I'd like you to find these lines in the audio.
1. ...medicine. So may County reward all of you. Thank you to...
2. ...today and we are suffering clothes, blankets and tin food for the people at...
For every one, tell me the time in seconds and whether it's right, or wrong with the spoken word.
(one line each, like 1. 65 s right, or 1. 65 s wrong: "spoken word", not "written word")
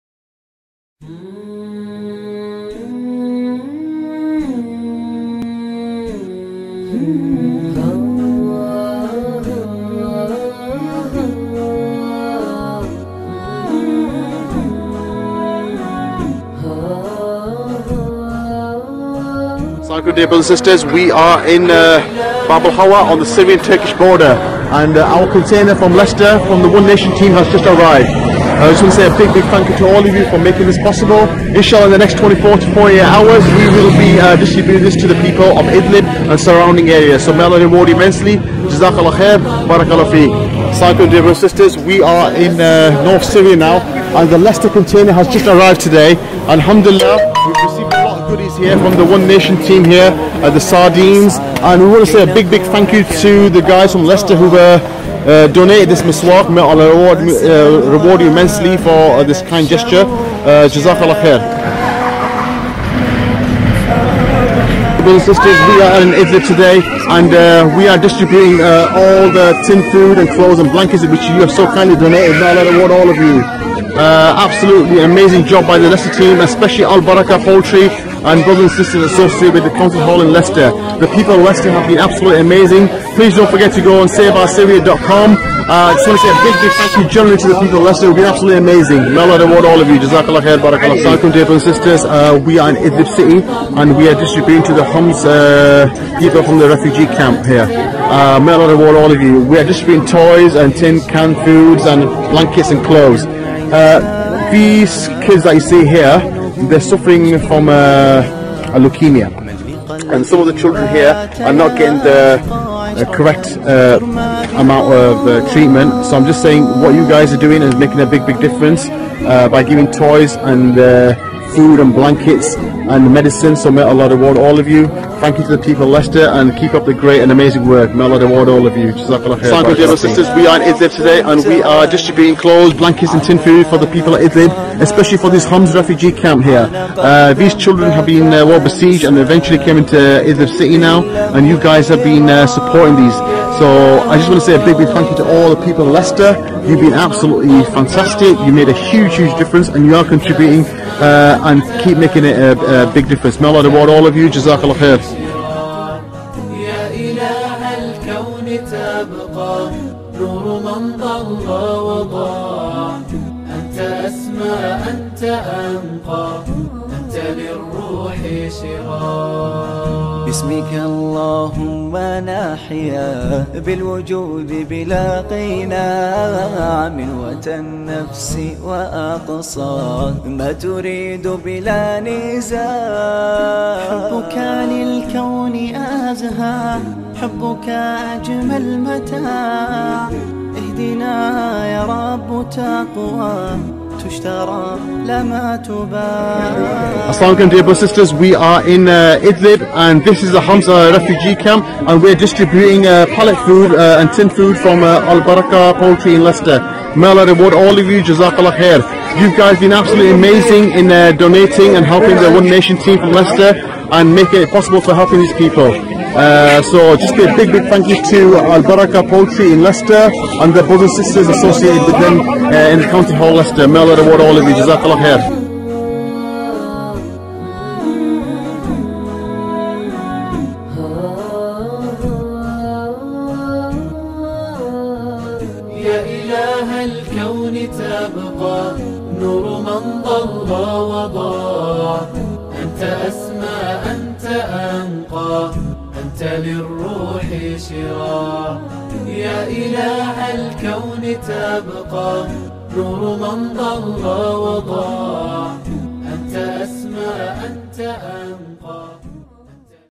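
1. 123 s wrong: "Allah", not "County"
2. 130 s wrong: "distributing", not "suffering".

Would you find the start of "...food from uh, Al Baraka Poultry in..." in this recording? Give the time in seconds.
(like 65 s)
204 s.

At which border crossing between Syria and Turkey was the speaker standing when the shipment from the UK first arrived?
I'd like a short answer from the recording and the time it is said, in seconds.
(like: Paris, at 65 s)
Bab Hawa, at 22 s.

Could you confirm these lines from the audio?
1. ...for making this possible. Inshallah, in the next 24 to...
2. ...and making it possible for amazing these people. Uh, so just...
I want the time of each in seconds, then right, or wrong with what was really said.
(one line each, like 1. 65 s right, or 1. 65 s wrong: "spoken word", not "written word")
1. 30 s right
2. 213 s wrong: "helping", not "amazing".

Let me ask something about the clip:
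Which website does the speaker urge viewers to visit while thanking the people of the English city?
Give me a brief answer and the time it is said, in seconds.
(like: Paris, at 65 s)
saveoursyria.com, at 84 s.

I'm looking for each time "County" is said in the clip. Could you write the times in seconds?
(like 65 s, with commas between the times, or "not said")
79 s, 222 s.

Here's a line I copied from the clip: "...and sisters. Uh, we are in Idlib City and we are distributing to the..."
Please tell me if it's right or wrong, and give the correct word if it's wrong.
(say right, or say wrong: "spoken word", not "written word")
right.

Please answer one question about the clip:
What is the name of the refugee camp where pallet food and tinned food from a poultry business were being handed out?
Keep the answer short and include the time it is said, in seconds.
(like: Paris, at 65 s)
Hamza refugee camp, at 200 s.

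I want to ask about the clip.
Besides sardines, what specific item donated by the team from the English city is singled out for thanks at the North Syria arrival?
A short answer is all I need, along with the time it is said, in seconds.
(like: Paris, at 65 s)
Miswak, at 56 s.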